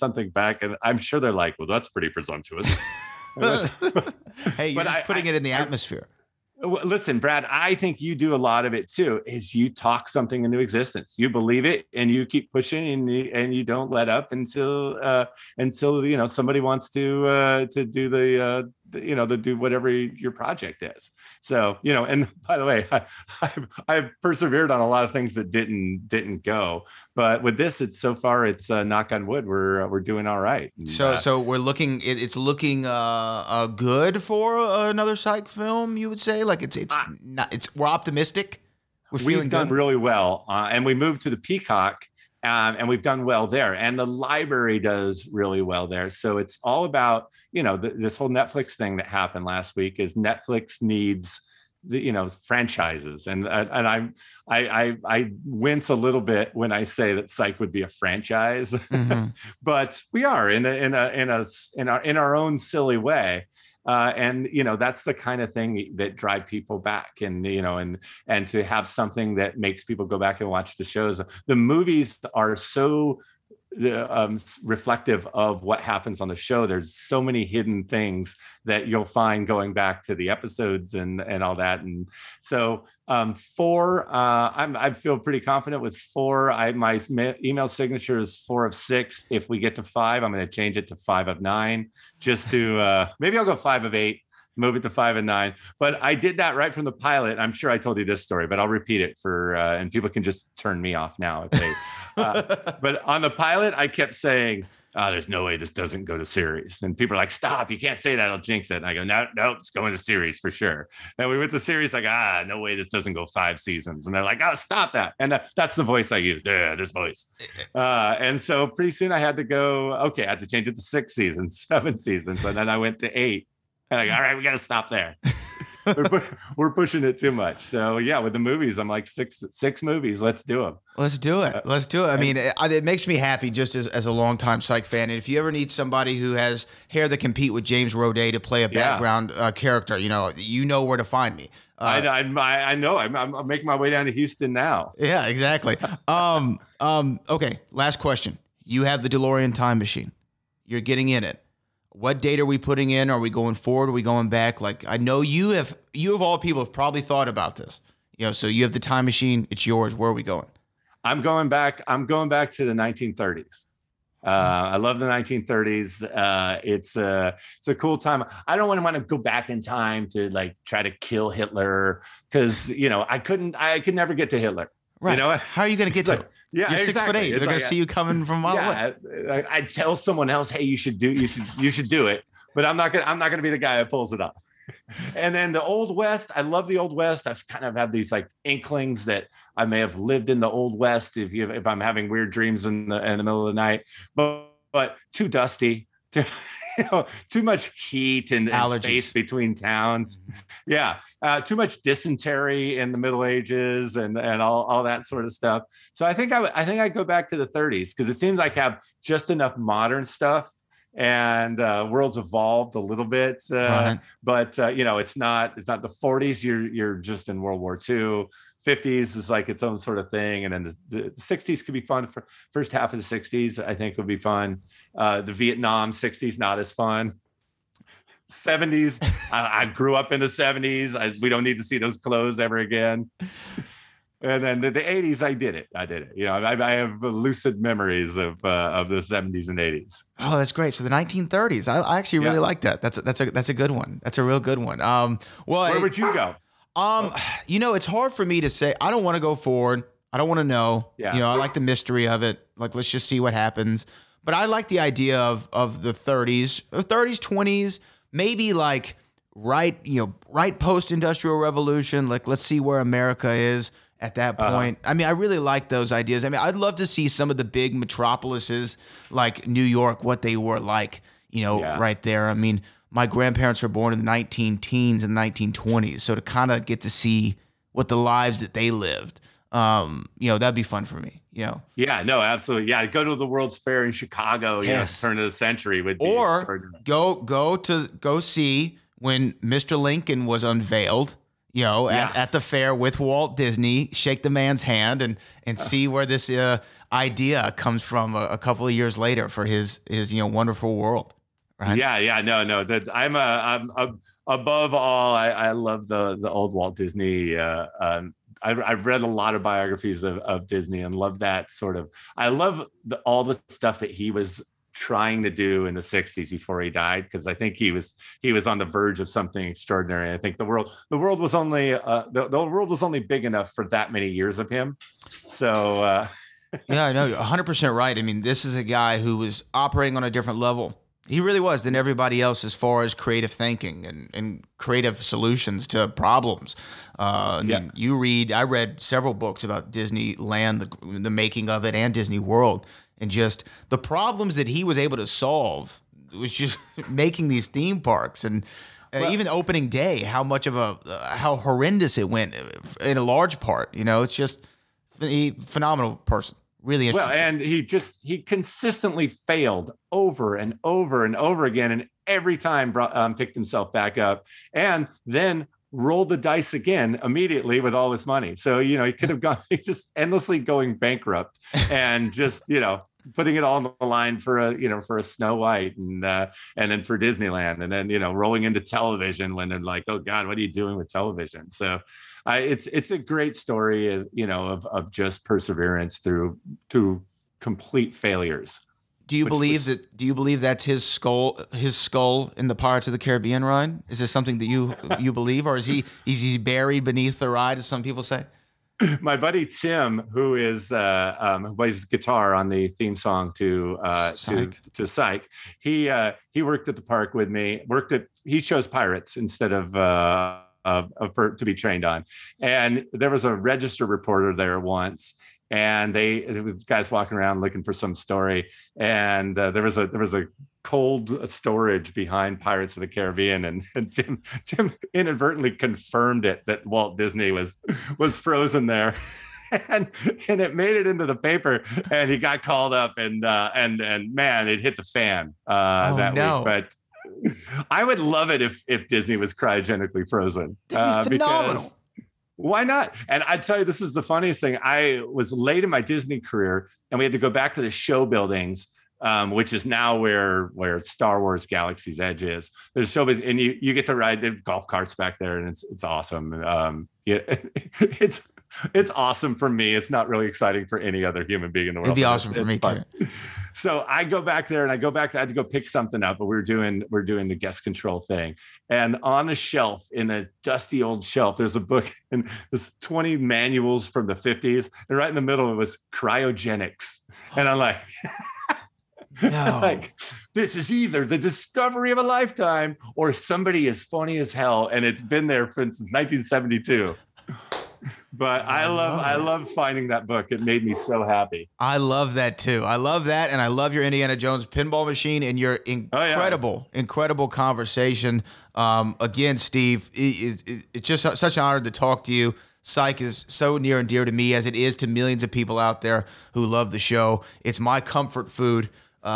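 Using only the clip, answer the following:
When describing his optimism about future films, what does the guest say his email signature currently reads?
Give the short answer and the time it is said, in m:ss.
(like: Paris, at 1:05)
4 of 6, at 1:28.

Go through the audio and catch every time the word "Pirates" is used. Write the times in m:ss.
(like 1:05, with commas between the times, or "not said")
6:32, 6:48, 7:02.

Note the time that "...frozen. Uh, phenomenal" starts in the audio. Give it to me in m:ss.
7:20.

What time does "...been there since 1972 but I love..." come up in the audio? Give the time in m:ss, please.
8:05.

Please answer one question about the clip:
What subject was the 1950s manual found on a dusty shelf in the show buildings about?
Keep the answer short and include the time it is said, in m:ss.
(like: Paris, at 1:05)
Cryogenics, at 7:55.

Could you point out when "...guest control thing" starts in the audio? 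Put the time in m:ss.
7:47.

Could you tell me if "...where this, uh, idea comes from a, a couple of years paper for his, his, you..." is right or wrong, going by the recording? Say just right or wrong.
wrong.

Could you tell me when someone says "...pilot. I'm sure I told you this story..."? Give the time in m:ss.
1:36.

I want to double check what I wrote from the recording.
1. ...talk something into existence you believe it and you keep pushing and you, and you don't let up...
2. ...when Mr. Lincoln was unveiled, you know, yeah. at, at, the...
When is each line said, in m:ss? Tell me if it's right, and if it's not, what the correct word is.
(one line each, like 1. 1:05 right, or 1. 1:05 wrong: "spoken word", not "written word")
1. 0:09 right
2. 4:48 right.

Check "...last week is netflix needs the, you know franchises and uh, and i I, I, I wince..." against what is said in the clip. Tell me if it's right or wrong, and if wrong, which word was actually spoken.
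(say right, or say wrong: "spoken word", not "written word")
right.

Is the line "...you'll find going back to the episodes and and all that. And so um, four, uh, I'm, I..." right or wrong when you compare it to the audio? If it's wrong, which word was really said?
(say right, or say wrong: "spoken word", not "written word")
right.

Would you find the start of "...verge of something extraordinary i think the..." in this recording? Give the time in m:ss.
5:18.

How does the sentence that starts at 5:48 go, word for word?
Uh, well, even opening day, how much of a uh, how horrendous it went uh, in a large part.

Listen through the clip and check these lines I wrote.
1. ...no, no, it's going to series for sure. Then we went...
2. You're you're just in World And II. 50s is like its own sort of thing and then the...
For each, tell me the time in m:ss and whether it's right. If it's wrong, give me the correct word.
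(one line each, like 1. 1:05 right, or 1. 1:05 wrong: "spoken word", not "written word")
1. 1:49 right
2. 3:36 wrong: "War", not "And".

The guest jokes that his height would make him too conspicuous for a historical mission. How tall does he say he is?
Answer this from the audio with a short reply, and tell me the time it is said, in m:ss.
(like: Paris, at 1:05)
6 foot 8, at 2:56.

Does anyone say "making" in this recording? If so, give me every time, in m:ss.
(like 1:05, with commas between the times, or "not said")
2:23, 5:41, 5:46.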